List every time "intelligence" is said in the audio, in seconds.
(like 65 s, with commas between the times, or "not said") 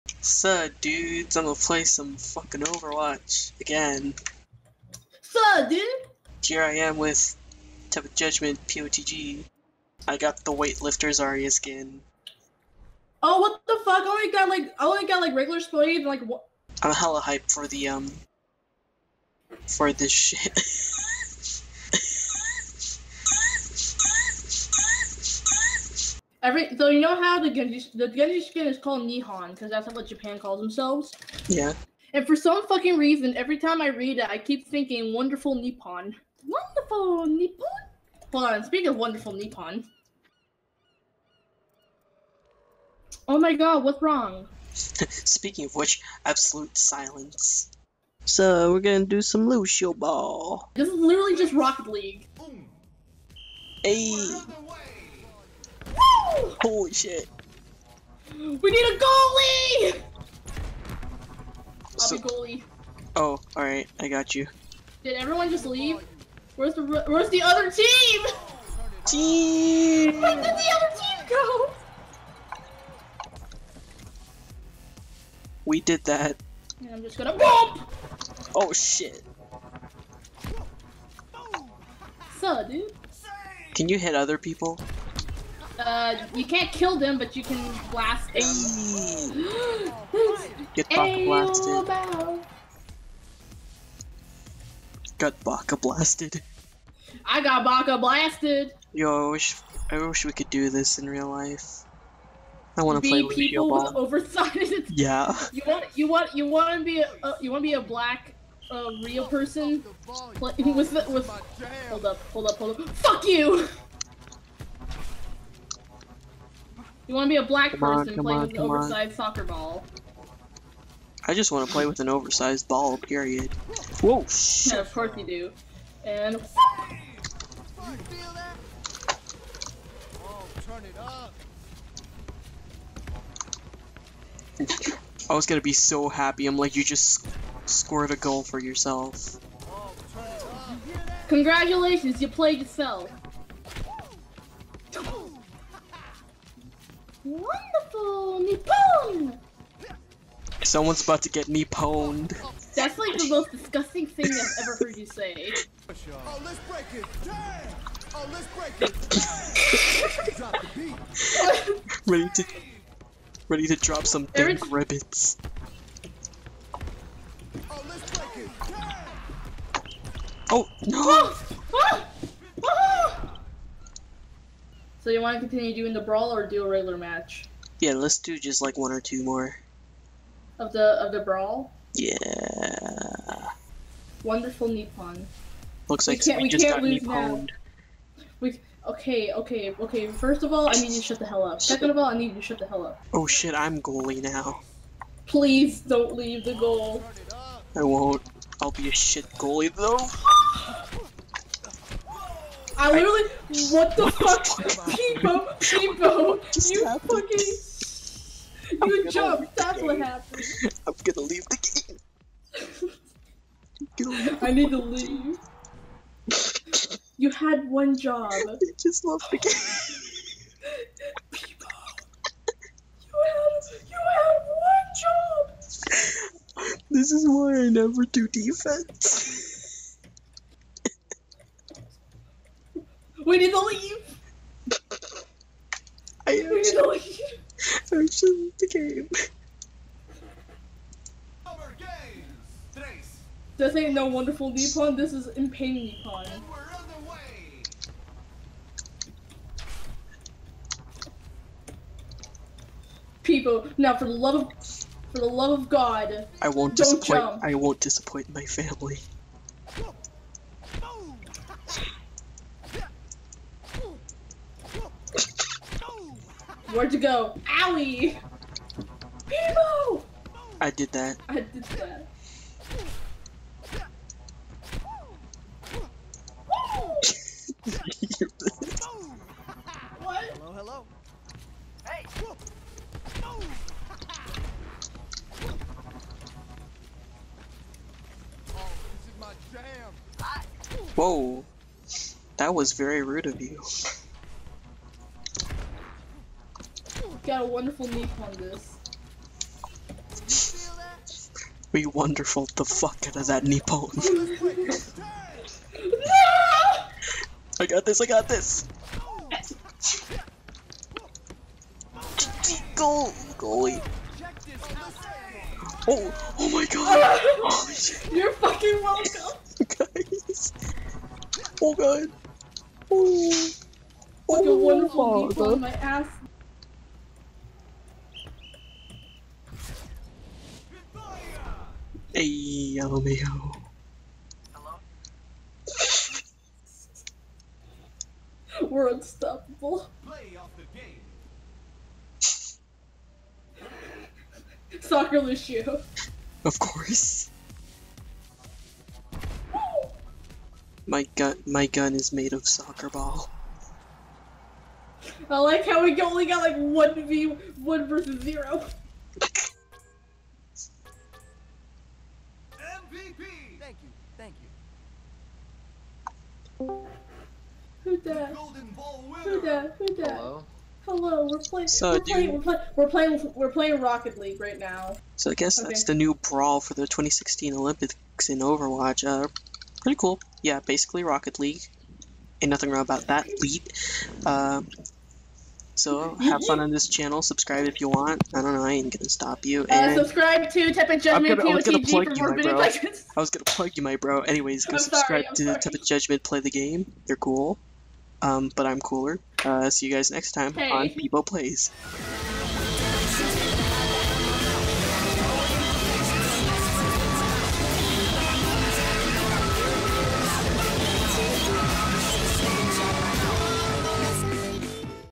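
not said.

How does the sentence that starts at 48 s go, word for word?
So we're gonna do some Lucio Ball.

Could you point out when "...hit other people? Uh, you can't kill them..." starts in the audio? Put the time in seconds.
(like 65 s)
83 s.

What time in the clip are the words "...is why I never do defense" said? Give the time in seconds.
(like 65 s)
227 s.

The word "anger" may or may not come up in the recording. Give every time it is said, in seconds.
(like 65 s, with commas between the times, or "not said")
not said.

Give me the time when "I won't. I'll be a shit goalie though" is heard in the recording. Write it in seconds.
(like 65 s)
197 s.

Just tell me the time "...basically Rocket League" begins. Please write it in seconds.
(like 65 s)
380 s.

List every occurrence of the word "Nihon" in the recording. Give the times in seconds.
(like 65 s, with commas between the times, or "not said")
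29 s.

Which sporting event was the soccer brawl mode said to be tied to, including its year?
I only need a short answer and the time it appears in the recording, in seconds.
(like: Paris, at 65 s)
2016 Olympics, at 376 s.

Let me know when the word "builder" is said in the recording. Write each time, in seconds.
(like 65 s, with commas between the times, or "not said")
not said.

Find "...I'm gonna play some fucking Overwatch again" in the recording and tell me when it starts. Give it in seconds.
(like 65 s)
1 s.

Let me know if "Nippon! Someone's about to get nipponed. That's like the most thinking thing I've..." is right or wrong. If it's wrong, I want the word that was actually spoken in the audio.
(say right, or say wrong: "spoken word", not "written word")
wrong: "disgusting", not "thinking".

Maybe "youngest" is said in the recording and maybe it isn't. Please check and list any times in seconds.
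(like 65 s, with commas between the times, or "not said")
not said.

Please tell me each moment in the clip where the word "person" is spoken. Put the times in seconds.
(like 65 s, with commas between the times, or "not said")
109 s, 117 s.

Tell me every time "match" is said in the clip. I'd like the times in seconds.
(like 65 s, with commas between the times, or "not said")
176 s.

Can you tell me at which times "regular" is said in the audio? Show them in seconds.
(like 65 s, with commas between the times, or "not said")
15 s, 176 s.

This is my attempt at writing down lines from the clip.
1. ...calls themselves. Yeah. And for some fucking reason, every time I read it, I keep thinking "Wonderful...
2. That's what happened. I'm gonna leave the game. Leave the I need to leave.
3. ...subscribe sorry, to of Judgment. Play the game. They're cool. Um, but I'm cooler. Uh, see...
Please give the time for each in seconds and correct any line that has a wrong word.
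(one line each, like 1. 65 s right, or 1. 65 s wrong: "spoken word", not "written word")
1. 30 s right
2. 209 s right
3. 394 s right.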